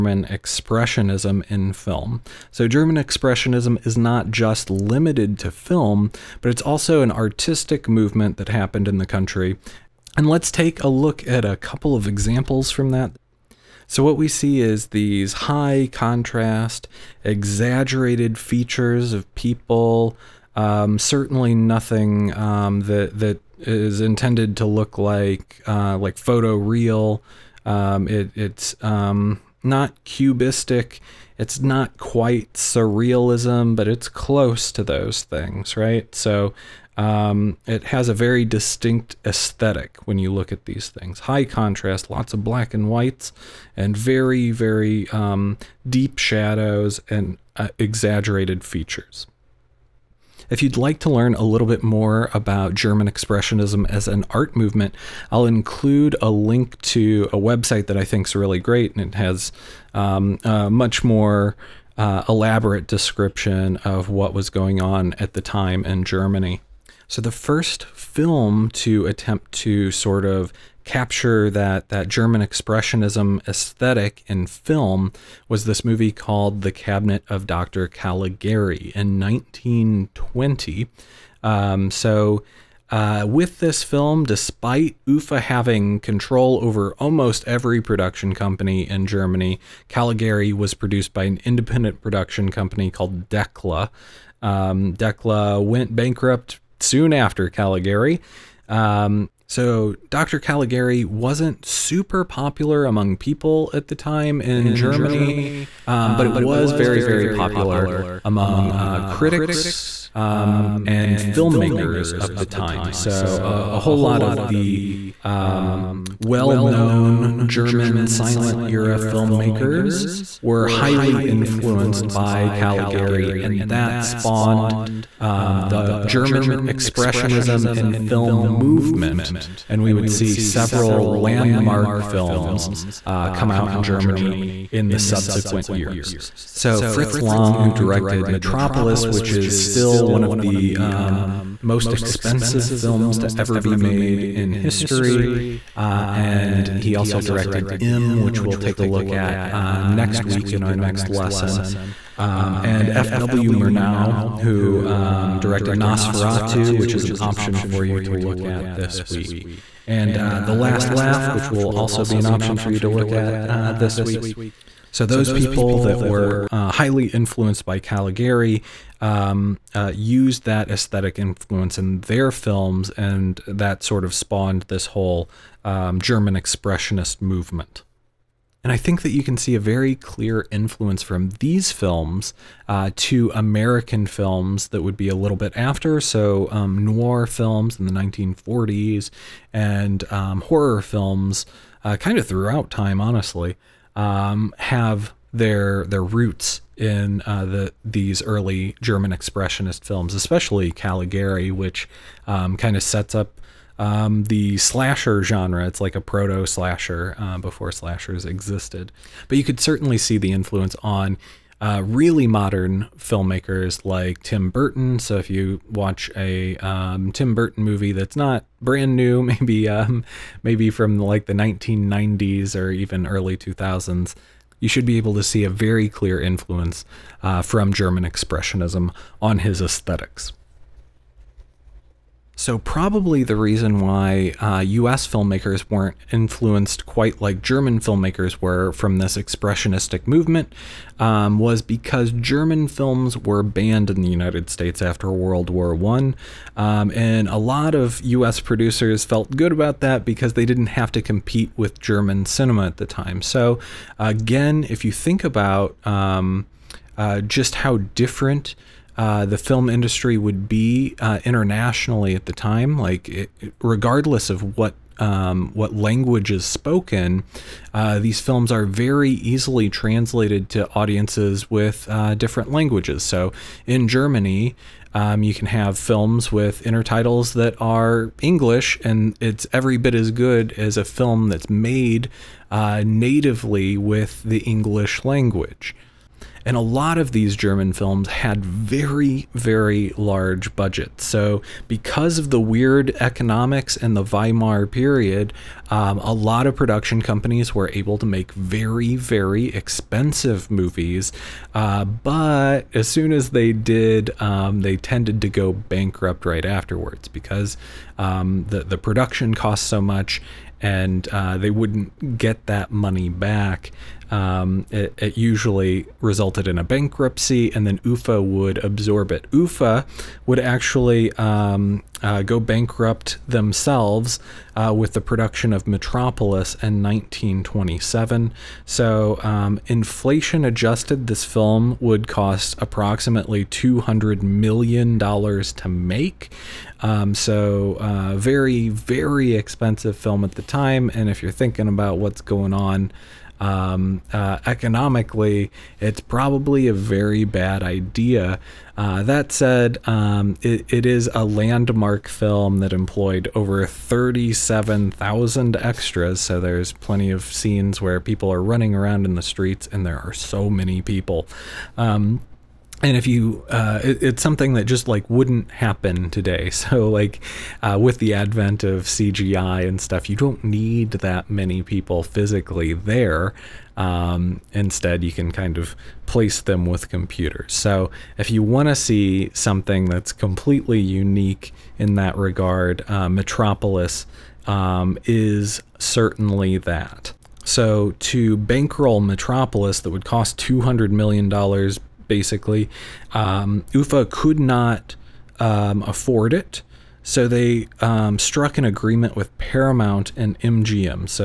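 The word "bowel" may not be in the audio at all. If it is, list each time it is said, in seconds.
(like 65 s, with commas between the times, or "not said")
not said.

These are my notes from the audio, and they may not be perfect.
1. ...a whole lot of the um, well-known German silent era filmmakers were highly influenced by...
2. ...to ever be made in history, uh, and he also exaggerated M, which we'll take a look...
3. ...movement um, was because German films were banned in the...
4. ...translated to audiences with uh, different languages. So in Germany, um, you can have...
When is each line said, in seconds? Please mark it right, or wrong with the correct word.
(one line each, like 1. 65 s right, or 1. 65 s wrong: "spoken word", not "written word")
1. 113 s right
2. 143 s wrong: "directed", not "exaggerated"
3. 240 s right
4. 269 s right.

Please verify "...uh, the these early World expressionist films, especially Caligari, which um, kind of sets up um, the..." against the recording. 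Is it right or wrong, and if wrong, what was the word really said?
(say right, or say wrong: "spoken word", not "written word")
wrong: "German", not "World".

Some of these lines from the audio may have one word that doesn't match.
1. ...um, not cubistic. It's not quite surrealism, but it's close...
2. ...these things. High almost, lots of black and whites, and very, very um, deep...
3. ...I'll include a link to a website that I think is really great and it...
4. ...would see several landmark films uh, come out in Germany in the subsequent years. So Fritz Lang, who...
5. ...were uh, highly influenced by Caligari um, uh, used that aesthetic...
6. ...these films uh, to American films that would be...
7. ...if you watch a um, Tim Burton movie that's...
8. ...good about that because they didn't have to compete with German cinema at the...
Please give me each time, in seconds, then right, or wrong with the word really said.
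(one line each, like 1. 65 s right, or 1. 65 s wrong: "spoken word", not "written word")
1. 28 s right
2. 40 s wrong: "contrast", not "almost"
3. 55 s right
4. 129 s right
5. 166 s right
6. 181 s right
7. 215 s right
8. 249 s right.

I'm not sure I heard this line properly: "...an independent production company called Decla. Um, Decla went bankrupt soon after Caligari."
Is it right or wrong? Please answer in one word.
right.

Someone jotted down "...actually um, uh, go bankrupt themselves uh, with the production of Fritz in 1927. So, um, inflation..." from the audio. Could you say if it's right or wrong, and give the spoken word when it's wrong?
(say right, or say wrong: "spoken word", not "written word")
wrong: "Metropolis", not "Fritz".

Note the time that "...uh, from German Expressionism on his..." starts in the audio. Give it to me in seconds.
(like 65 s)
227 s.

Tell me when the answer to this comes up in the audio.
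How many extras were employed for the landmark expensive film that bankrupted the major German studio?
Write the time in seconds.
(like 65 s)
353 s.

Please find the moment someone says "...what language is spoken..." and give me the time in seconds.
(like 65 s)
265 s.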